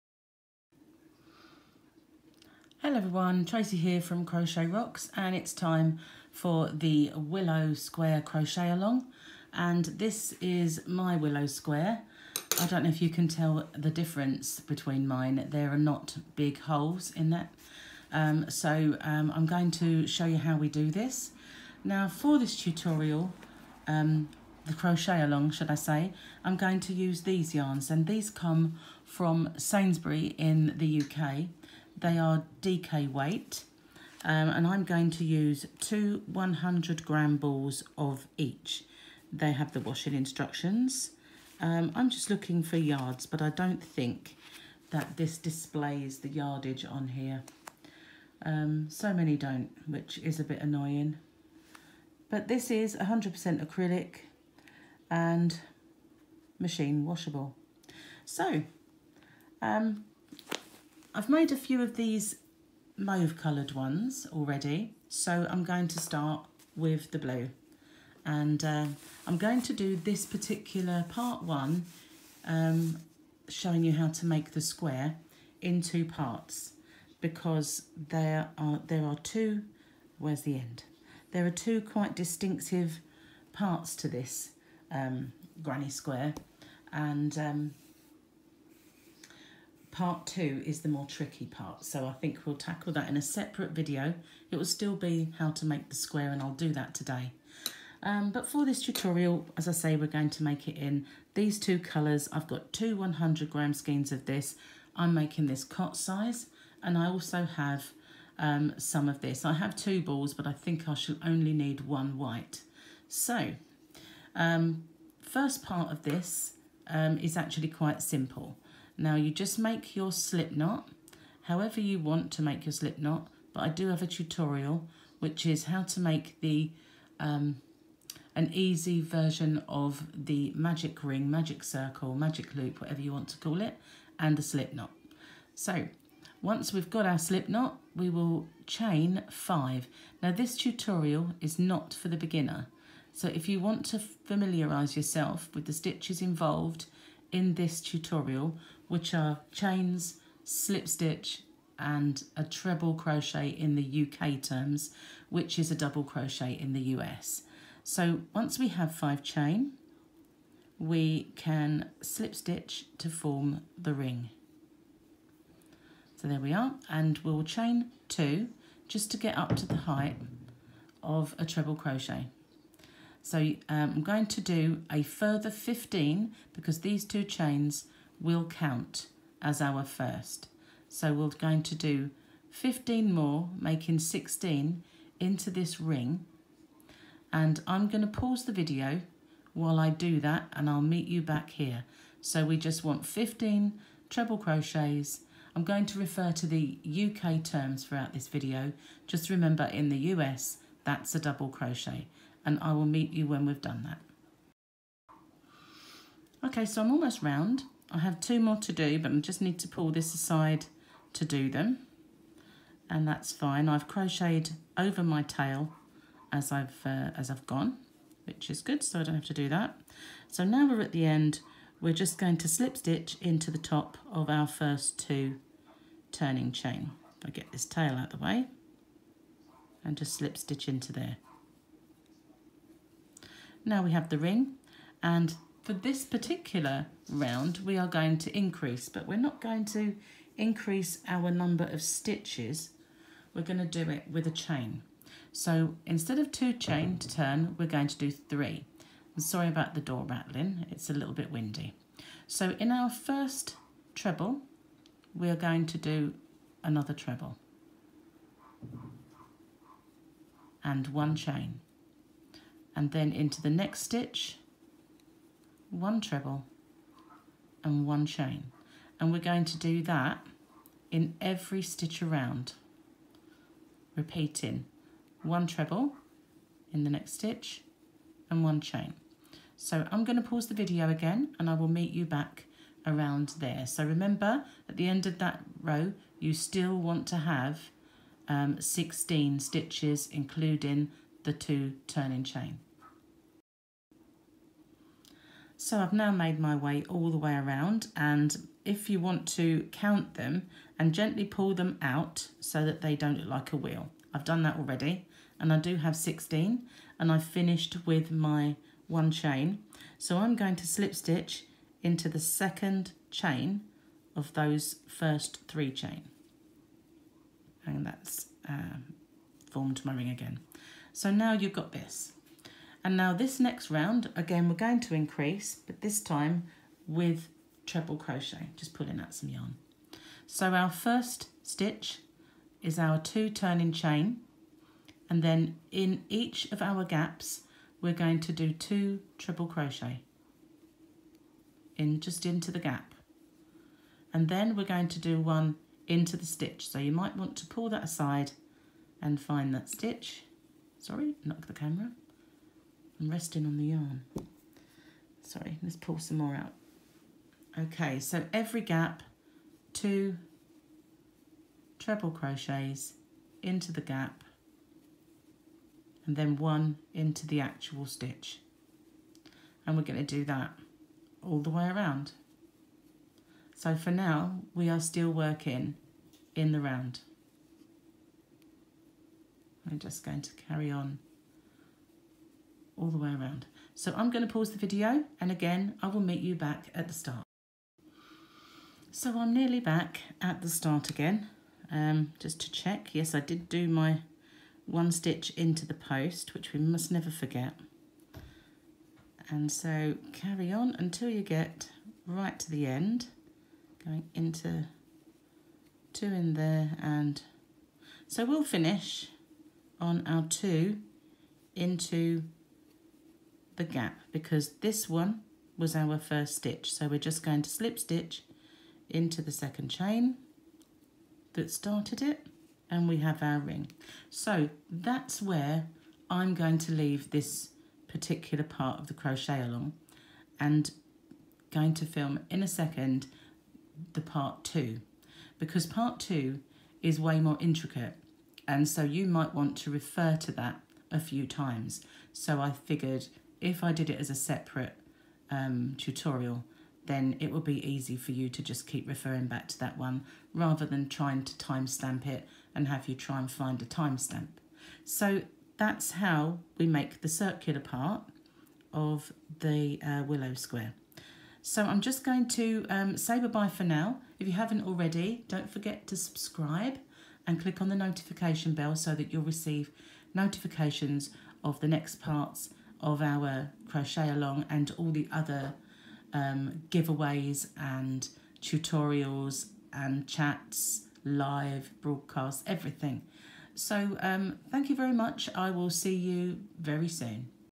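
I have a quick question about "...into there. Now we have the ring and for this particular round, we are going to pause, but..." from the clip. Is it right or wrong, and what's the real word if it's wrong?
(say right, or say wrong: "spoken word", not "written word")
wrong: "increase", not "pause".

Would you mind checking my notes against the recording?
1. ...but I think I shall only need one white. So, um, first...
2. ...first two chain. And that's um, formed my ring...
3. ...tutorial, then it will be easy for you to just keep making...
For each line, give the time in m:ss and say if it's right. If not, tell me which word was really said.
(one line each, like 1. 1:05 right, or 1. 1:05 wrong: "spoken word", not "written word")
1. 1:50 right
2. 5:14 wrong: "three", not "two"
3. 7:25 wrong: "referring", not "making".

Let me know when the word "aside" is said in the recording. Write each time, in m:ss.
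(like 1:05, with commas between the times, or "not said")
3:30, 5:47.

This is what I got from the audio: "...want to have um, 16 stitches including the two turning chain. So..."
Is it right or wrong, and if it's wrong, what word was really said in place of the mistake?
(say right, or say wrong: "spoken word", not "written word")
right.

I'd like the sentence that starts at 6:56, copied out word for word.
So we're just going to slip stitch into the second chain that started it and we have our ring.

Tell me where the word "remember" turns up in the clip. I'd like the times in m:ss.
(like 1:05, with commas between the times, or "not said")
3:19, 4:43.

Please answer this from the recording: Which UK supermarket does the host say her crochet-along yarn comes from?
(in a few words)
Sainsbury.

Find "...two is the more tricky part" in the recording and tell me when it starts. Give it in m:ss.
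1:30.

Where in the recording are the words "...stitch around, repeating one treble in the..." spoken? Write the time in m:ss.
4:31.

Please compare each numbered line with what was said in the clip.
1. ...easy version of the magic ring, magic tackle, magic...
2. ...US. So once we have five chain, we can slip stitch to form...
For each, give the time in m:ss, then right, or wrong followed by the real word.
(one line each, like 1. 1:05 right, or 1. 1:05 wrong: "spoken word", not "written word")
1. 2:08 wrong: "circle", not "tackle"
2. 2:36 right.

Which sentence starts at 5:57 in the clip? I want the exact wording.
Okay, so every gap, two treble crochets into the gap and then one into the actual stitch.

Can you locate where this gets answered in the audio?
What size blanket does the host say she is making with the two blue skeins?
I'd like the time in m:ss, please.
1:45.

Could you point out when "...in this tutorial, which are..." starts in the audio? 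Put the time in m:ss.
2:27.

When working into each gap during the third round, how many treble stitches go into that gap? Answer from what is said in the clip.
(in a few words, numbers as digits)
2.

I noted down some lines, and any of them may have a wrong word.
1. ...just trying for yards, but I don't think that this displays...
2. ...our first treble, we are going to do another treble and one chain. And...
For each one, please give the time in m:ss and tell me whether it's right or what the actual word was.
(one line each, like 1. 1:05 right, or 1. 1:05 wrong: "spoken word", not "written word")
1. 0:42 wrong: "looking", not "trying"
2. 4:12 right.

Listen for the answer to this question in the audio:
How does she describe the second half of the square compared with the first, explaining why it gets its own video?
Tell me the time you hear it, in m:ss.
7:17.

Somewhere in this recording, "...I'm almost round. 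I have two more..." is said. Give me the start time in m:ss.
3:26.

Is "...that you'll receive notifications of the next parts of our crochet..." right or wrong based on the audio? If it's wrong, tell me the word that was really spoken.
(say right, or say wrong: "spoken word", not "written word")
right.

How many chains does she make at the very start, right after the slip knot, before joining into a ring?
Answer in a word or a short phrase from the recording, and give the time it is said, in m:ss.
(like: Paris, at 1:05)
5, at 2:18.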